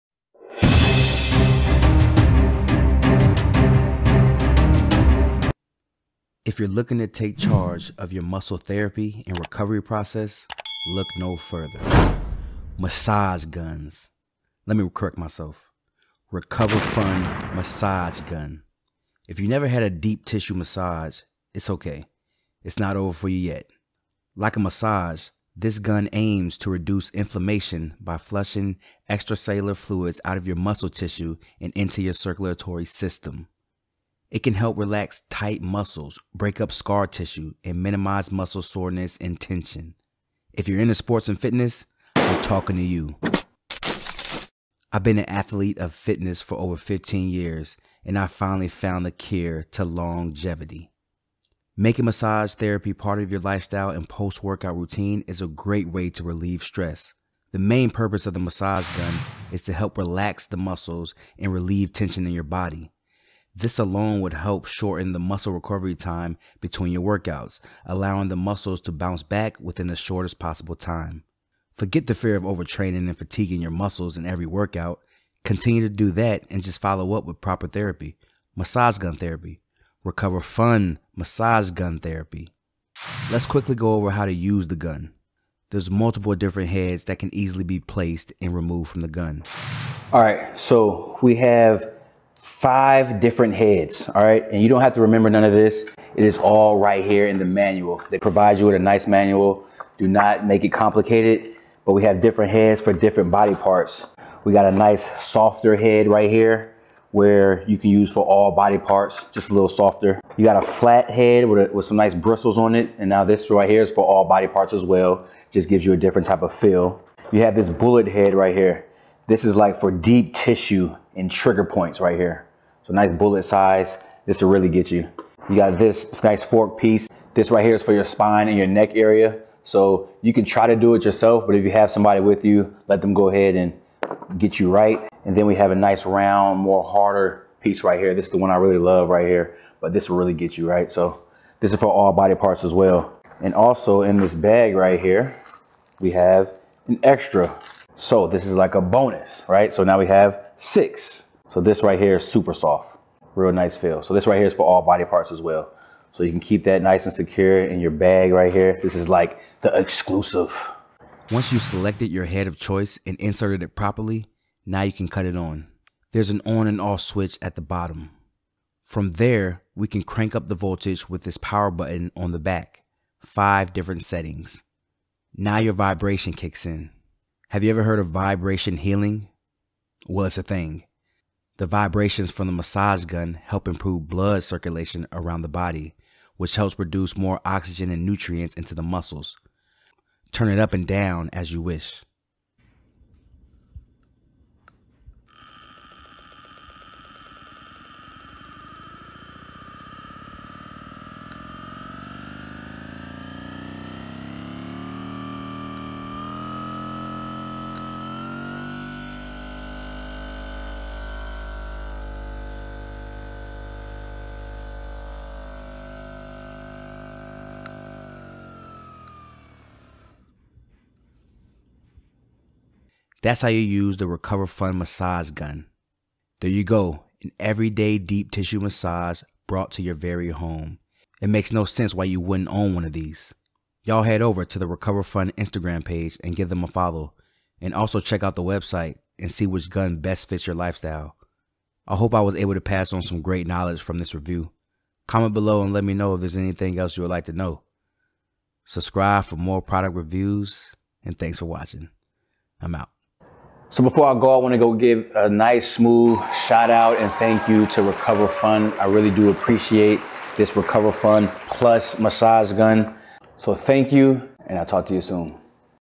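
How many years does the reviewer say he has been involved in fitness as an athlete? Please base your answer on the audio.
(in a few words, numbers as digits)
15.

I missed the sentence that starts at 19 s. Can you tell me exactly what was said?
If you never had a deep tissue massage, it's okay.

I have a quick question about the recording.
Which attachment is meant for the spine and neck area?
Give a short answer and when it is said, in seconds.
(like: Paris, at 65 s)
fork piece, at 126 s.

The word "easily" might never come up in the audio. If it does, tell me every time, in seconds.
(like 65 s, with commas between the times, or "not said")
87 s.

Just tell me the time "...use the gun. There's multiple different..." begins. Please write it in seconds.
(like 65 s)
84 s.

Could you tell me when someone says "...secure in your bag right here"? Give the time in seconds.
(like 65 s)
157 s.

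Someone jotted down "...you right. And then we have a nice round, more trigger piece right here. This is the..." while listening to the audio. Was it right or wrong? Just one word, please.
wrong.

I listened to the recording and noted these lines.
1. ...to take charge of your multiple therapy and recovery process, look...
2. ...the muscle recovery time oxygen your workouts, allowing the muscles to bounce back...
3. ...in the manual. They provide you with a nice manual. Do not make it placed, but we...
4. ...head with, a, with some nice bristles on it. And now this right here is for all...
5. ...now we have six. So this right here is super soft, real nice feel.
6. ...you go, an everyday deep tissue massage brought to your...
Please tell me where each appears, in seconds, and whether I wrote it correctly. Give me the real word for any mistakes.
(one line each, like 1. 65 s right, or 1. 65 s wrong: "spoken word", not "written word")
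1. 6 s wrong: "muscle", not "multiple"
2. 65 s wrong: "between", not "oxygen"
3. 97 s wrong: "complicated", not "placed"
4. 111 s right
5. 149 s right
6. 226 s right.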